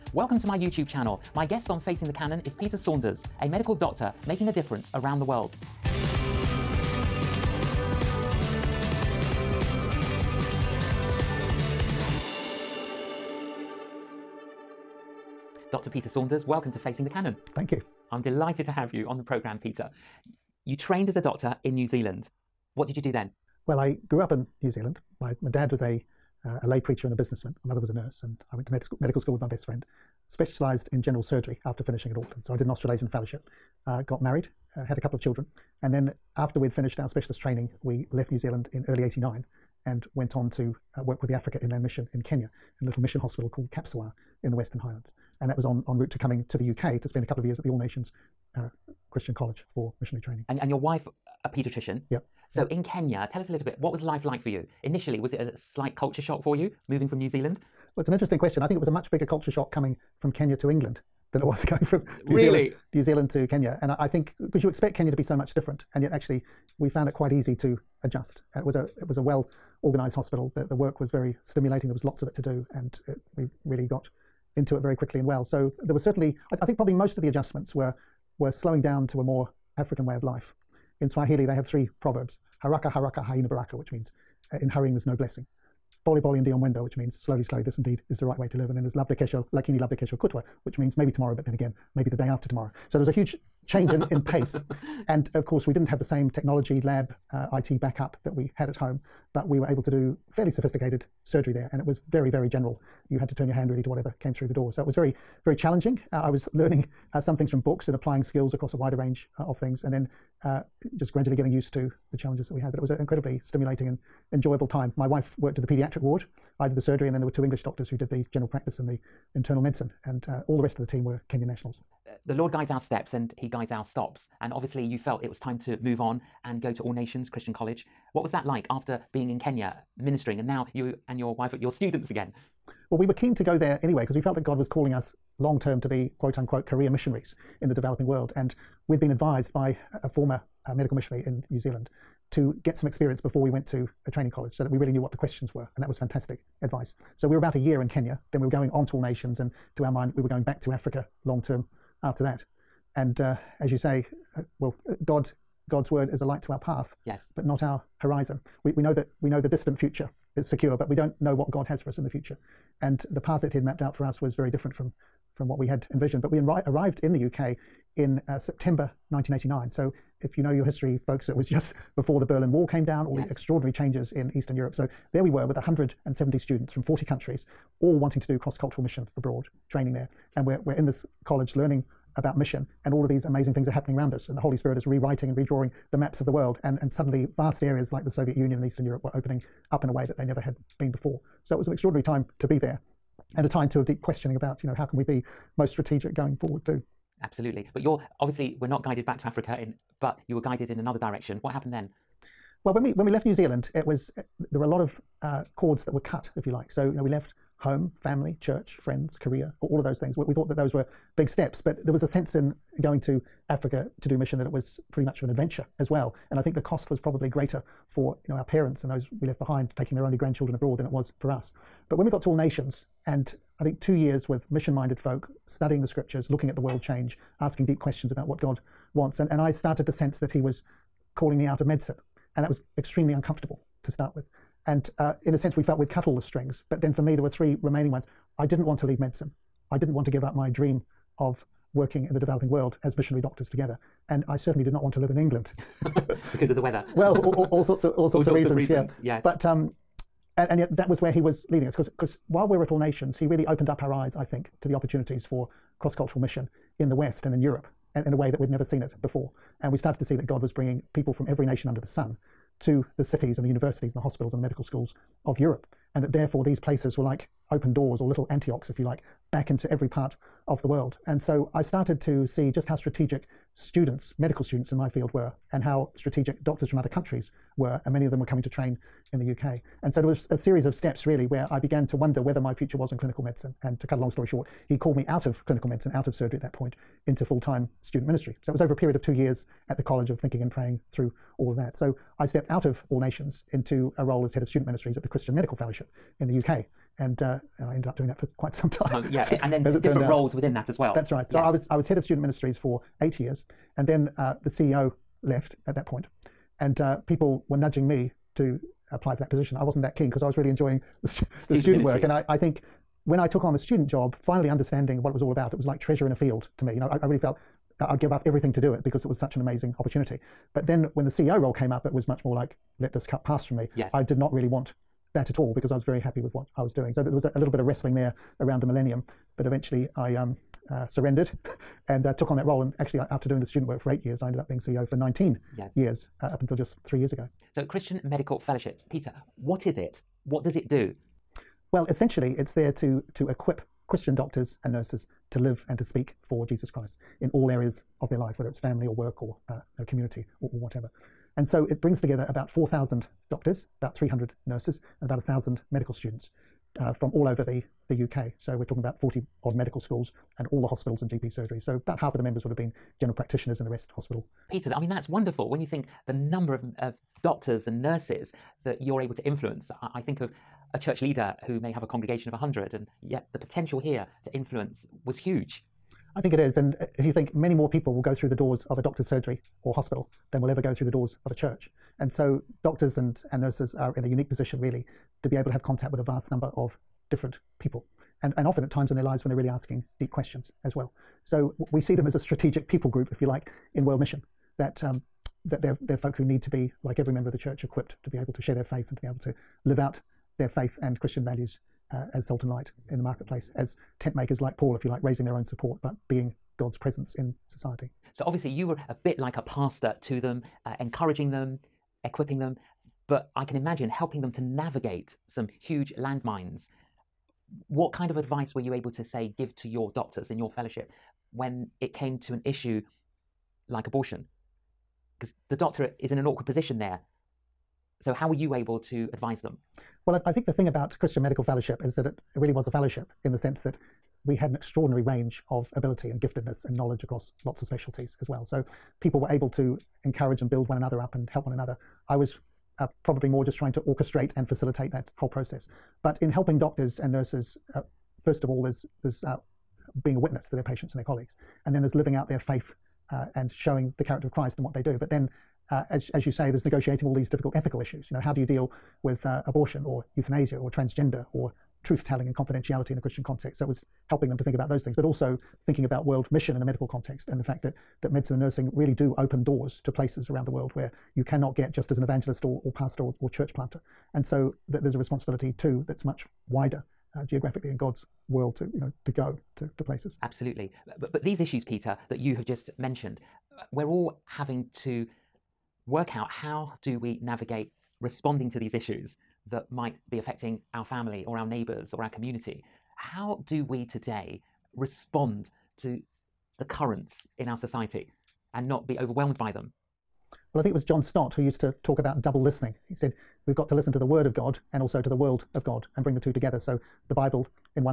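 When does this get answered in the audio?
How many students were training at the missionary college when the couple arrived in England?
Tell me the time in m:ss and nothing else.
2:55.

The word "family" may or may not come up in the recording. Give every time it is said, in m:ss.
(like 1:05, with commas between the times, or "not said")
3:27, 5:48, 8:10.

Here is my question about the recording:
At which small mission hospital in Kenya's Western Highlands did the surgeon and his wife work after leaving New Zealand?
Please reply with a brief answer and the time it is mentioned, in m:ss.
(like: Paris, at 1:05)
Kapsowar, at 0:43.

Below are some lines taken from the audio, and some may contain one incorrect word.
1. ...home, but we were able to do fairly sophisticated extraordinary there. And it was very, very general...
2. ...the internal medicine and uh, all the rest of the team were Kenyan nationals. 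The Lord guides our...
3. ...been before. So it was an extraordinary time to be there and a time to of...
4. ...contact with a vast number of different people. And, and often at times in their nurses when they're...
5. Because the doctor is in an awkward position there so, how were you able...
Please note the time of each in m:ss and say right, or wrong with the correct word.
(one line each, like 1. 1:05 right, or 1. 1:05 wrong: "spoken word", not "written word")
1. 1:38 wrong: "surgery", not "extraordinary"
2. 1:58 right
3. 3:10 right
4. 6:25 wrong: "lives", not "nurses"
5. 7:05 right.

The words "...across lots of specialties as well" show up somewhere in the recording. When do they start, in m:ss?
7:17.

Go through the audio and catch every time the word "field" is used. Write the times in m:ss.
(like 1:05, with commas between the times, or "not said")
4:34, 5:16.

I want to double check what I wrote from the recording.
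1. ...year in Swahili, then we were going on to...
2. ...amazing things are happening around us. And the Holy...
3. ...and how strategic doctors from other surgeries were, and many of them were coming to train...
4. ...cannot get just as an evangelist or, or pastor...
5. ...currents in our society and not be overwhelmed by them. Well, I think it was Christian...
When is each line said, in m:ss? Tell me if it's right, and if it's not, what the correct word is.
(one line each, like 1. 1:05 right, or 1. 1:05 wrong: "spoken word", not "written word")
1. 2:27 wrong: "Kenya", not "Swahili"
2. 3:03 right
3. 4:35 wrong: "countries", not "surgeries"
4. 7:51 right
5. 8:16 wrong: "John", not "Christian".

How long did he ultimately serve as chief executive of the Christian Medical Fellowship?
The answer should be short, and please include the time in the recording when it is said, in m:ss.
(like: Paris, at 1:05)
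19 years, at 5:34.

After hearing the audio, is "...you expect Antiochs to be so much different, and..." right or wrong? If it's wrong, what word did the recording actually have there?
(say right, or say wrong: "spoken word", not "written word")
wrong: "Kenya", not "Antiochs".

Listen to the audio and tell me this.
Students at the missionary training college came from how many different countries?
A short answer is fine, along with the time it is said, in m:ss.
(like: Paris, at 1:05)
40, at 2:56.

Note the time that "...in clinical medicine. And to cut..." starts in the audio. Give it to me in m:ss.
4:42.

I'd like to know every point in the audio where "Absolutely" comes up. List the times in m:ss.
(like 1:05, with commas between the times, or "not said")
3:17, 8:00.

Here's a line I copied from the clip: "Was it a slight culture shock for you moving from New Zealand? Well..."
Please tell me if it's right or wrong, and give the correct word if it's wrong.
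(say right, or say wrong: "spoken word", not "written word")
right.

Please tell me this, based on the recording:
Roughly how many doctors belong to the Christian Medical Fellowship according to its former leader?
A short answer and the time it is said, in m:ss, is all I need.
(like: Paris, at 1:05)
4,000, at 5:52.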